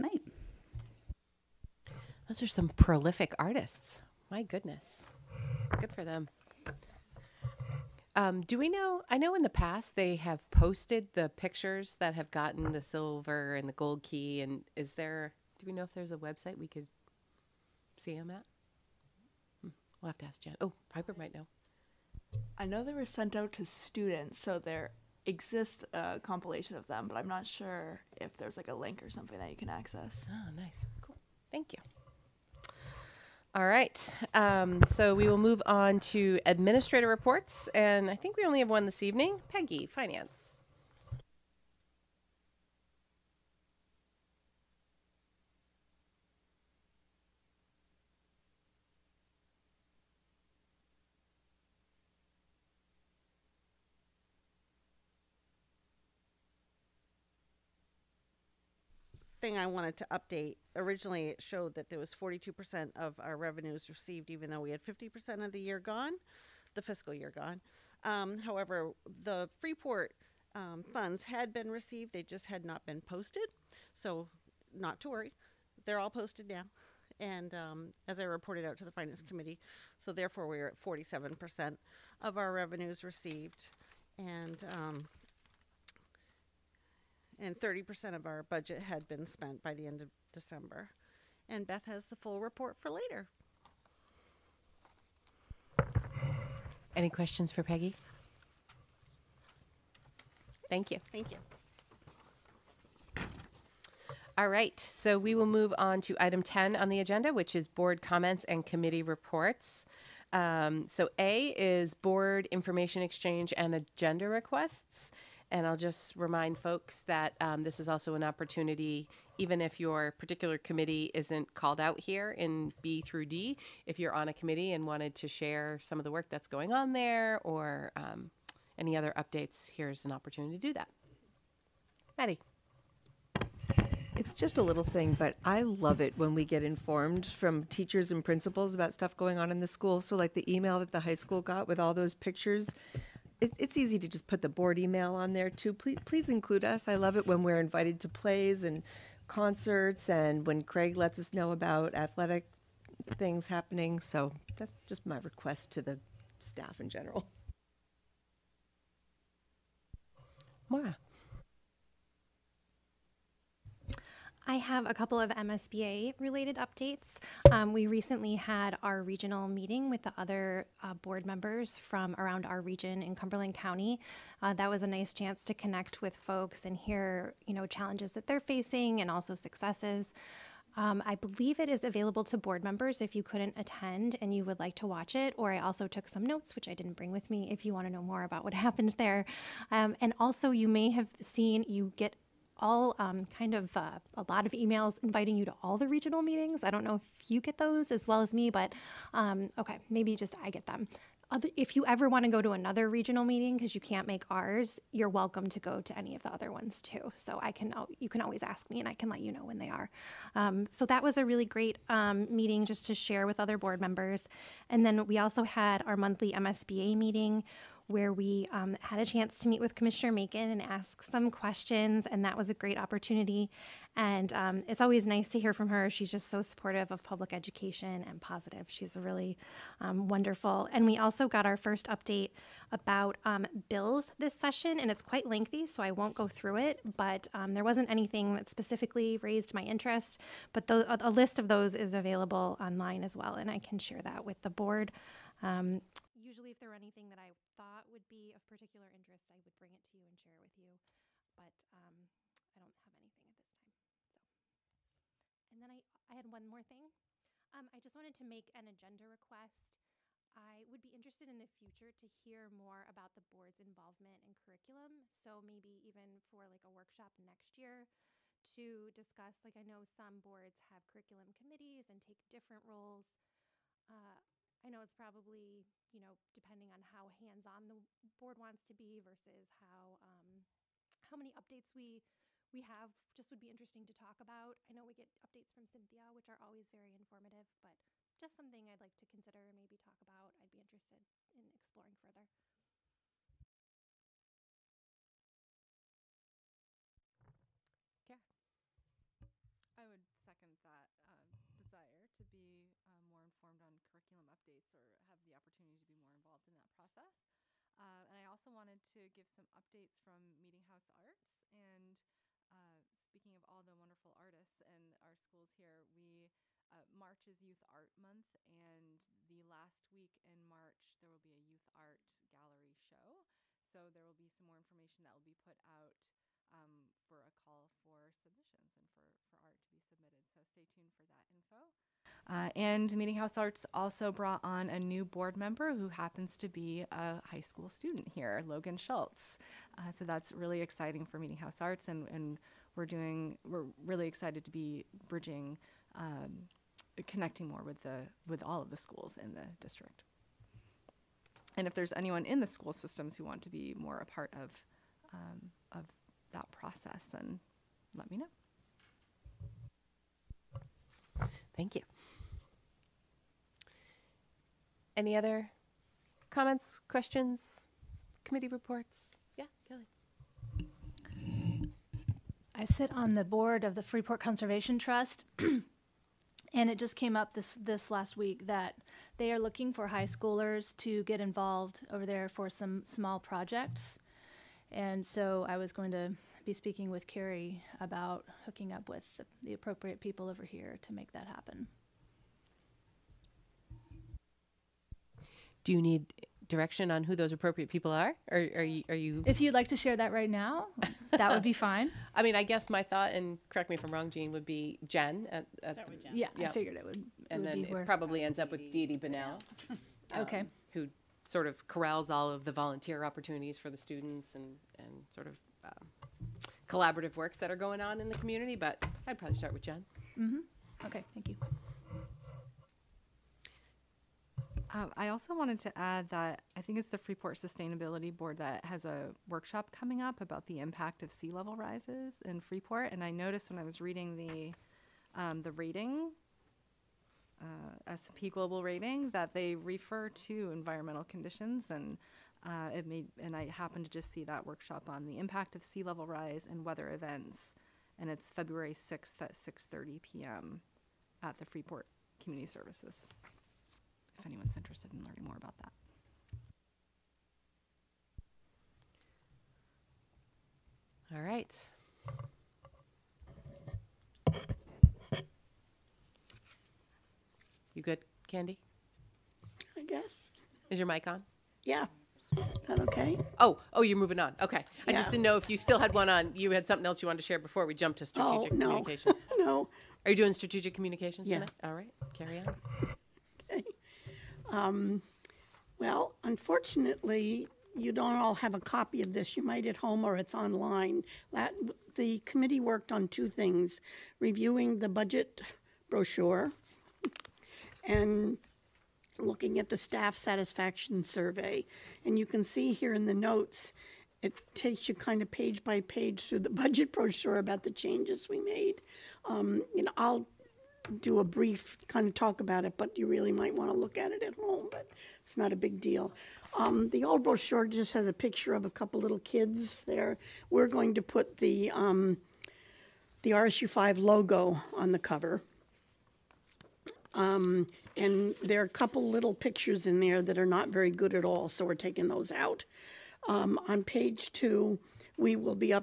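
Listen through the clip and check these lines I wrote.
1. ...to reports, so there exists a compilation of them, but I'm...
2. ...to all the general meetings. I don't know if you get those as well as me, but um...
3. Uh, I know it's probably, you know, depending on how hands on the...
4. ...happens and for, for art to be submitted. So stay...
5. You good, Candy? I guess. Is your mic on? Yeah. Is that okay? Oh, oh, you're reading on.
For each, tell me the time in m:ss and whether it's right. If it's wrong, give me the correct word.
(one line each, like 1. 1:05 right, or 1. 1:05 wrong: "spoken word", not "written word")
1. 0:23 wrong: "students", not "reports"
2. 3:15 wrong: "regional", not "general"
3. 4:33 right
4. 5:28 wrong: "submissions", not "happens"
5. 7:47 wrong: "moving", not "reading".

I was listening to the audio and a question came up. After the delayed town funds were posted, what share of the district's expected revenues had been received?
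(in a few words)
47%.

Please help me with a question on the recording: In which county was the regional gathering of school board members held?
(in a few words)
Cumberland County.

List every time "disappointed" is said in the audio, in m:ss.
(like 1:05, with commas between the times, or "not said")
not said.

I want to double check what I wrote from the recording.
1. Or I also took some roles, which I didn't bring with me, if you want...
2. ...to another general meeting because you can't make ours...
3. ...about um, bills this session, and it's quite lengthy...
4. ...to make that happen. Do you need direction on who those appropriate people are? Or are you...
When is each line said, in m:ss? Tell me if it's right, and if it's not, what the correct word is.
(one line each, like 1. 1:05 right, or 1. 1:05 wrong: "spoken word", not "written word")
1. 3:05 wrong: "notes", not "roles"
2. 3:22 wrong: "regional", not "general"
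3. 3:52 right
4. 6:30 right.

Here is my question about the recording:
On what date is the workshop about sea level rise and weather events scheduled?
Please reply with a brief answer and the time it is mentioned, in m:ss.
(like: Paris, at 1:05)
February 6, at 7:28.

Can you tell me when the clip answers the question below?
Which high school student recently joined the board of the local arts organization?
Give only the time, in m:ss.
5:38.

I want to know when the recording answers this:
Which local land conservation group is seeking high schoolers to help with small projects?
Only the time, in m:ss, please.
6:13.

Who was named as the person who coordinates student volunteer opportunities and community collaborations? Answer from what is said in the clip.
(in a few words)
Dee Dee Bunnell.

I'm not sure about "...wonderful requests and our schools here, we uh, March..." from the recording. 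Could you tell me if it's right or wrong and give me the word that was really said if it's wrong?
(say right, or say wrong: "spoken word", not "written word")
wrong: "artists", not "requests".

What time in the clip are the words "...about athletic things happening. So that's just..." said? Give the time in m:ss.
2:31.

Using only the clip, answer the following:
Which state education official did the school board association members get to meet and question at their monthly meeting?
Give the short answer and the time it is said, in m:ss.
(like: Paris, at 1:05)
Commissioner Makin, at 3:39.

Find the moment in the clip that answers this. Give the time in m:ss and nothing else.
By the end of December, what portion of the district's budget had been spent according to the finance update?
1:27.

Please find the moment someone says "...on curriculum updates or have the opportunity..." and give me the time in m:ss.
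5:03.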